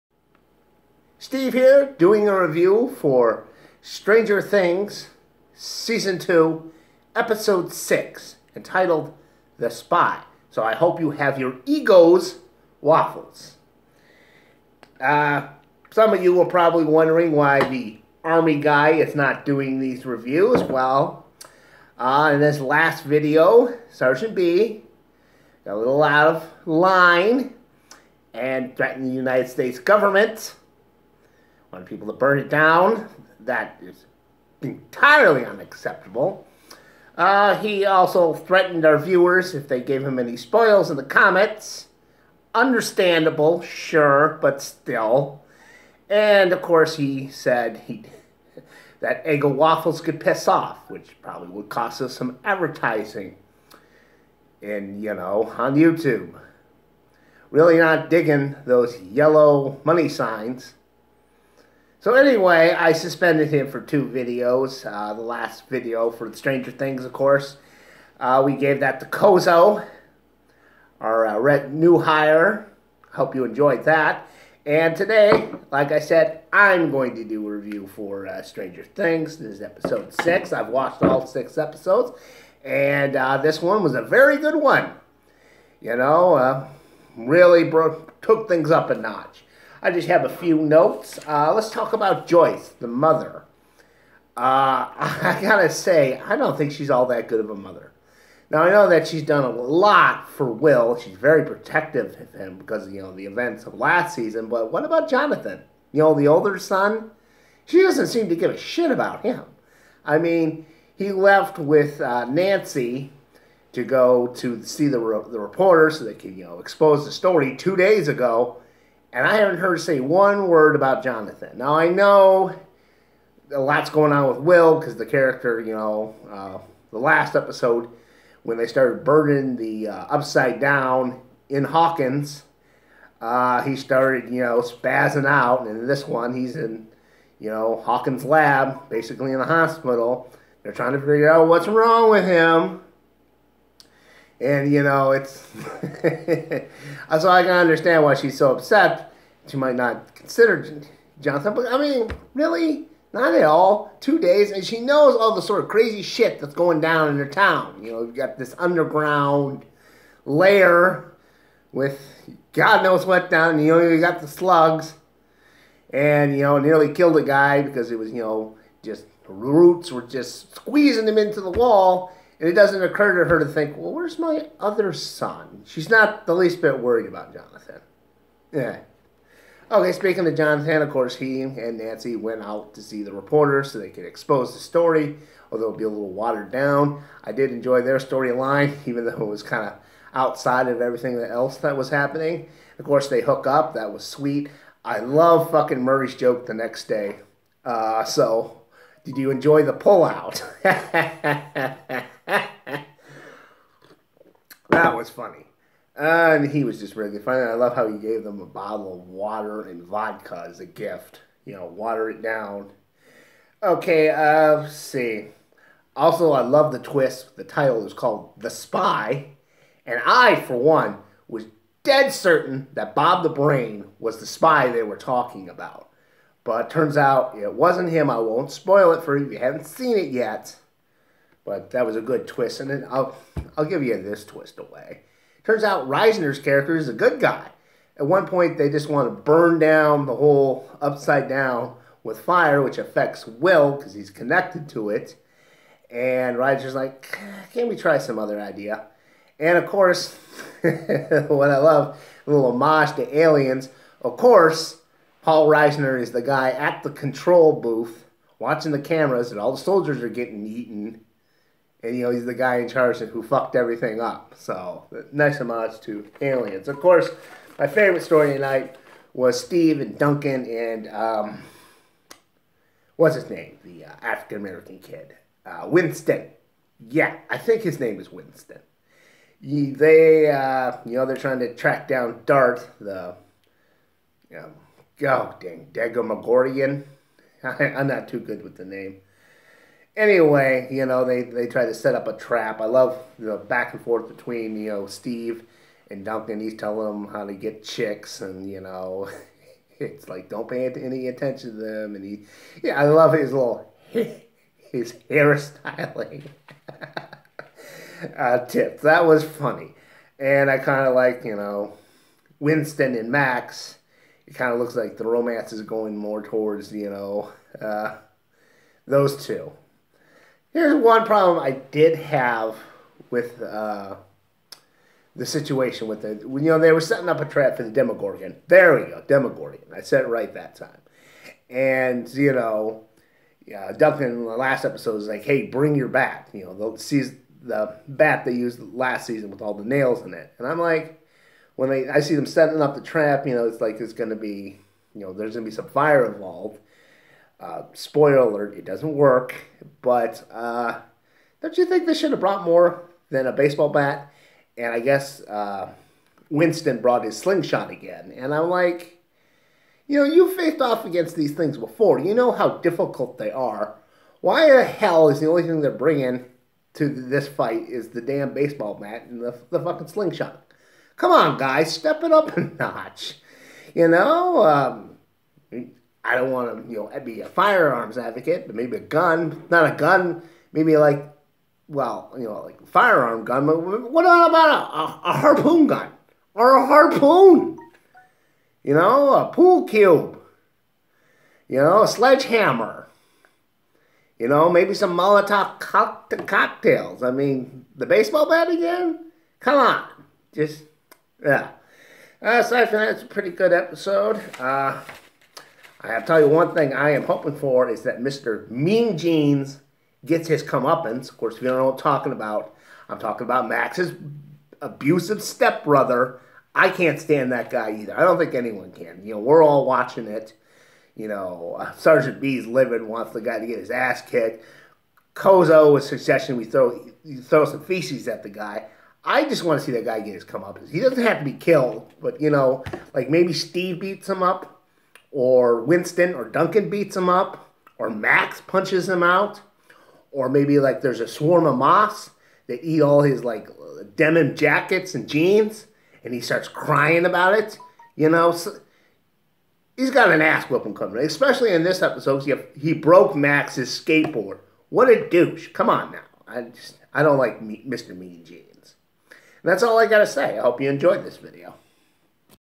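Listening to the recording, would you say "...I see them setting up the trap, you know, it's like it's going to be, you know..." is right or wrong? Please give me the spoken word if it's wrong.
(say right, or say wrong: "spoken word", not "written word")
right.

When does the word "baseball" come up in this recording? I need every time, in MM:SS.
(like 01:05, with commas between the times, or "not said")
05:53, 06:08, 06:37.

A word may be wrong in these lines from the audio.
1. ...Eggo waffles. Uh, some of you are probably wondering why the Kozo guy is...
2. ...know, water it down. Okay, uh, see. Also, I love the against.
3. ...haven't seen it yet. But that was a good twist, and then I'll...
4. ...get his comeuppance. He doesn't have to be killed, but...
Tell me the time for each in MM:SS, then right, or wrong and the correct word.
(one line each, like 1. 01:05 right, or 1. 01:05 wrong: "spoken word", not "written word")
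1. 00:11 wrong: "Army", not "Kozo"
2. 03:31 wrong: "twist", not "against"
3. 03:49 right
4. 07:09 right.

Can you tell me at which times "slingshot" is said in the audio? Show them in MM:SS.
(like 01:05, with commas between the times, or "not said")
05:57, 06:09.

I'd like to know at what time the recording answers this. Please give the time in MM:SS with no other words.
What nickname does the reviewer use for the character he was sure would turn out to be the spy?
03:42.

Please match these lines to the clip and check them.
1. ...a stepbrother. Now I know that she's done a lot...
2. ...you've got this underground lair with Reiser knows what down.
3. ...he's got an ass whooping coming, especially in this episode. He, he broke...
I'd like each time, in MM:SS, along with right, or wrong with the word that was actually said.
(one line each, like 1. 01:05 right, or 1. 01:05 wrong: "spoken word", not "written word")
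1. 01:37 wrong: "mother", not "stepbrother"
2. 02:38 wrong: "God", not "Reiser"
3. 07:29 right.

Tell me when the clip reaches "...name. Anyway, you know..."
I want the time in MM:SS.
04:48.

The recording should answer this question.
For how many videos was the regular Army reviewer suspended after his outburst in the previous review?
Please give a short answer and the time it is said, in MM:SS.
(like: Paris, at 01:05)
2, at 01:03.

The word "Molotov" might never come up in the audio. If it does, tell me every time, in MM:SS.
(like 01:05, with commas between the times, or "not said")
06:34.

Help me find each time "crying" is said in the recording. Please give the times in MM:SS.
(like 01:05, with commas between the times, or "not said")
07:26.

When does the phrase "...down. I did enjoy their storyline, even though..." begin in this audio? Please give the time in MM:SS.
03:06.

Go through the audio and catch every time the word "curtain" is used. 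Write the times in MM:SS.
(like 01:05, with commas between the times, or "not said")
not said.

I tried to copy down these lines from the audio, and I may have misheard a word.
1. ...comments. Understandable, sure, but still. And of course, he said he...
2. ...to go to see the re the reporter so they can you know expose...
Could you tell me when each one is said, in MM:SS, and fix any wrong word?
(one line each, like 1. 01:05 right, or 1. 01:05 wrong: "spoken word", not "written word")
1. 00:41 right
2. 01:53 right.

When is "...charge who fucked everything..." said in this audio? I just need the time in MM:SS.
04:22.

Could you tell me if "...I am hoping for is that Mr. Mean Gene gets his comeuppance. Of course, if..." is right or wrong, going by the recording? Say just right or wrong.
wrong.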